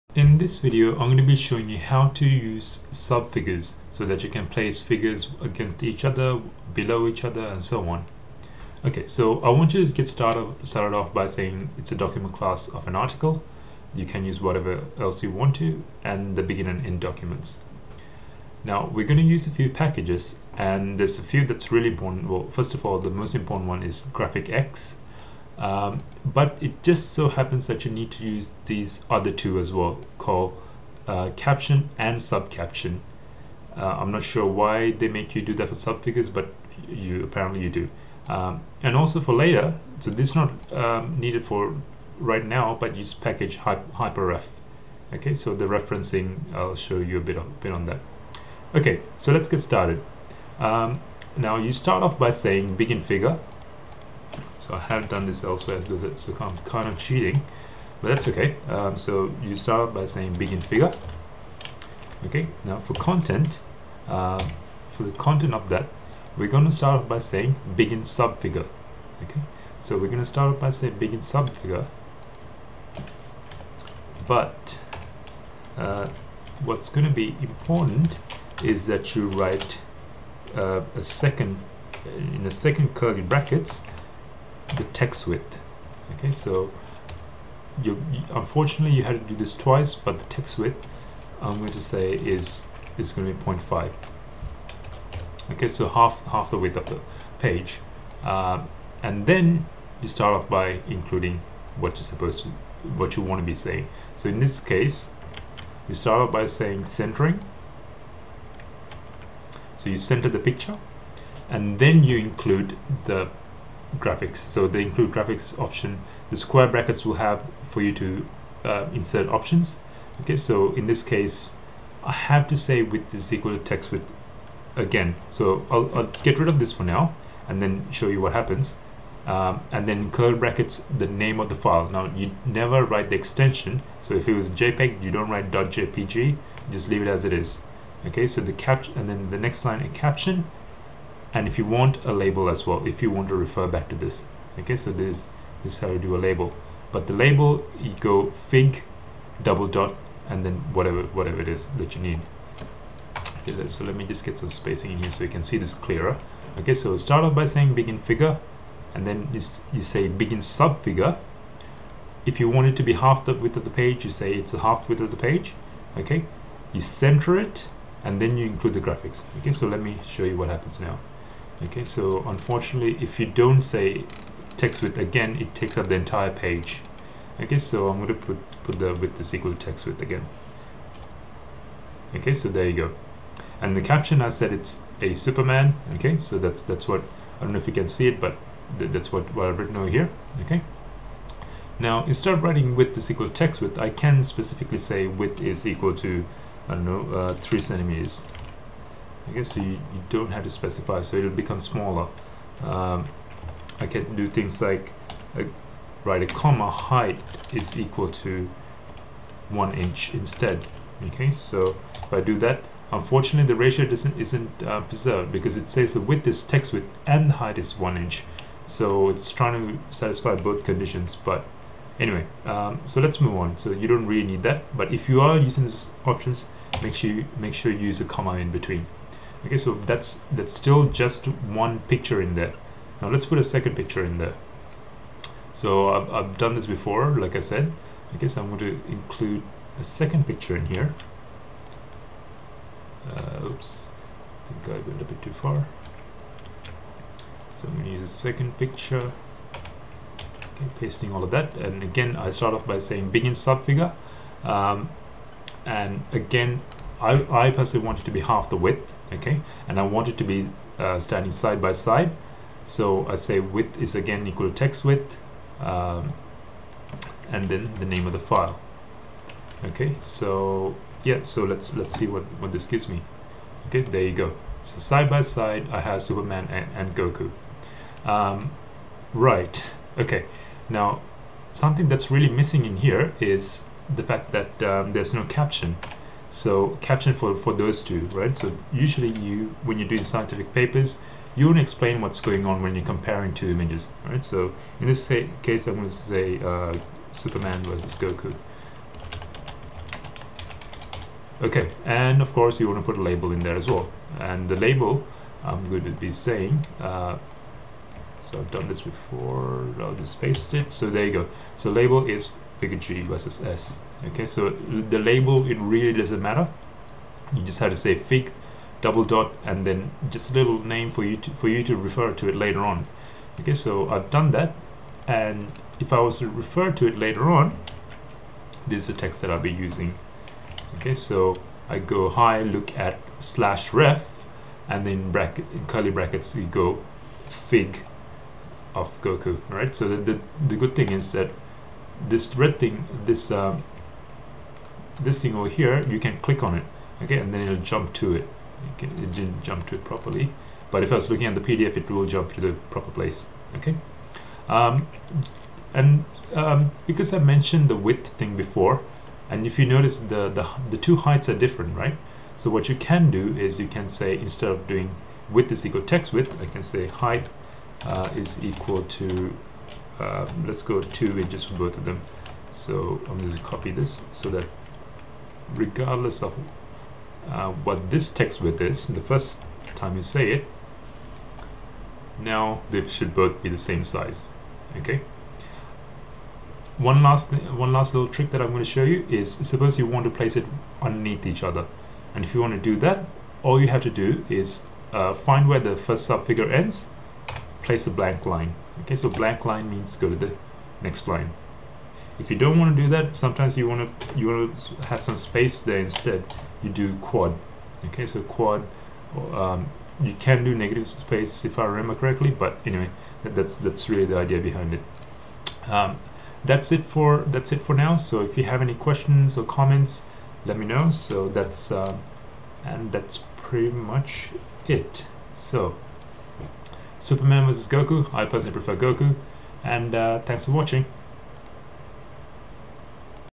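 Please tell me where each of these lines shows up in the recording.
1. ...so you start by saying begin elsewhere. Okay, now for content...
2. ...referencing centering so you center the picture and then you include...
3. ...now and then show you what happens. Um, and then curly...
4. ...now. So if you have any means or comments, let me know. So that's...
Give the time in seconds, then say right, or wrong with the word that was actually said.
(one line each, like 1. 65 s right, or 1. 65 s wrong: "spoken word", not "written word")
1. 58 s wrong: "figure", not "elsewhere"
2. 106 s wrong: "saying", not "referencing"
3. 126 s right
4. 417 s wrong: "questions", not "means".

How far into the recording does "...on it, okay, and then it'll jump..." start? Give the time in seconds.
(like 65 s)
346 s.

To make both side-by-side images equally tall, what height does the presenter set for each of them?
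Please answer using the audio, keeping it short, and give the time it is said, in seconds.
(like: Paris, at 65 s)
two inches, at 370 s.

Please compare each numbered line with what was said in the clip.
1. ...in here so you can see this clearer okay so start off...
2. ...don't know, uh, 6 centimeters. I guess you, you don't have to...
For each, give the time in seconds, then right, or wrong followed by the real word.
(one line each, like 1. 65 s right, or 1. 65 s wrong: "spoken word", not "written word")
1. 154 s right
2. 196 s wrong: "3", not "6".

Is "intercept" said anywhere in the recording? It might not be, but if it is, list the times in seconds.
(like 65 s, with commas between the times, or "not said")
not said.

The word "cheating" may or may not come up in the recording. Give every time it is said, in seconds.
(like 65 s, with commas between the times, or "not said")
56 s.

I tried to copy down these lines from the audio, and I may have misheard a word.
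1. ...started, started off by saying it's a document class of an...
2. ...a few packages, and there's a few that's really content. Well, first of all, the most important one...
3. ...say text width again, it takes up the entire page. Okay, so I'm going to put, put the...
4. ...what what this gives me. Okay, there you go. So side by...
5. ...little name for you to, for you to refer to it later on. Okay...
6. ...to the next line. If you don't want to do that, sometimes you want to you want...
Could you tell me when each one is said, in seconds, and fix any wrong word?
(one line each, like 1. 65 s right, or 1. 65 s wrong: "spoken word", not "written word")
1. 10 s right
2. 19 s wrong: "important", not "content"
3. 173 s right
4. 272 s right
5. 320 s right
6. 400 s right.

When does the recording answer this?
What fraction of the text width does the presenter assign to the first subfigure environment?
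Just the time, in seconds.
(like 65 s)
93 s.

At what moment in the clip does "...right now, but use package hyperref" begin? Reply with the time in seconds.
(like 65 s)
42 s.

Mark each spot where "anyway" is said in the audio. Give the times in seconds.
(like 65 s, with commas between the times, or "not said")
222 s, 412 s.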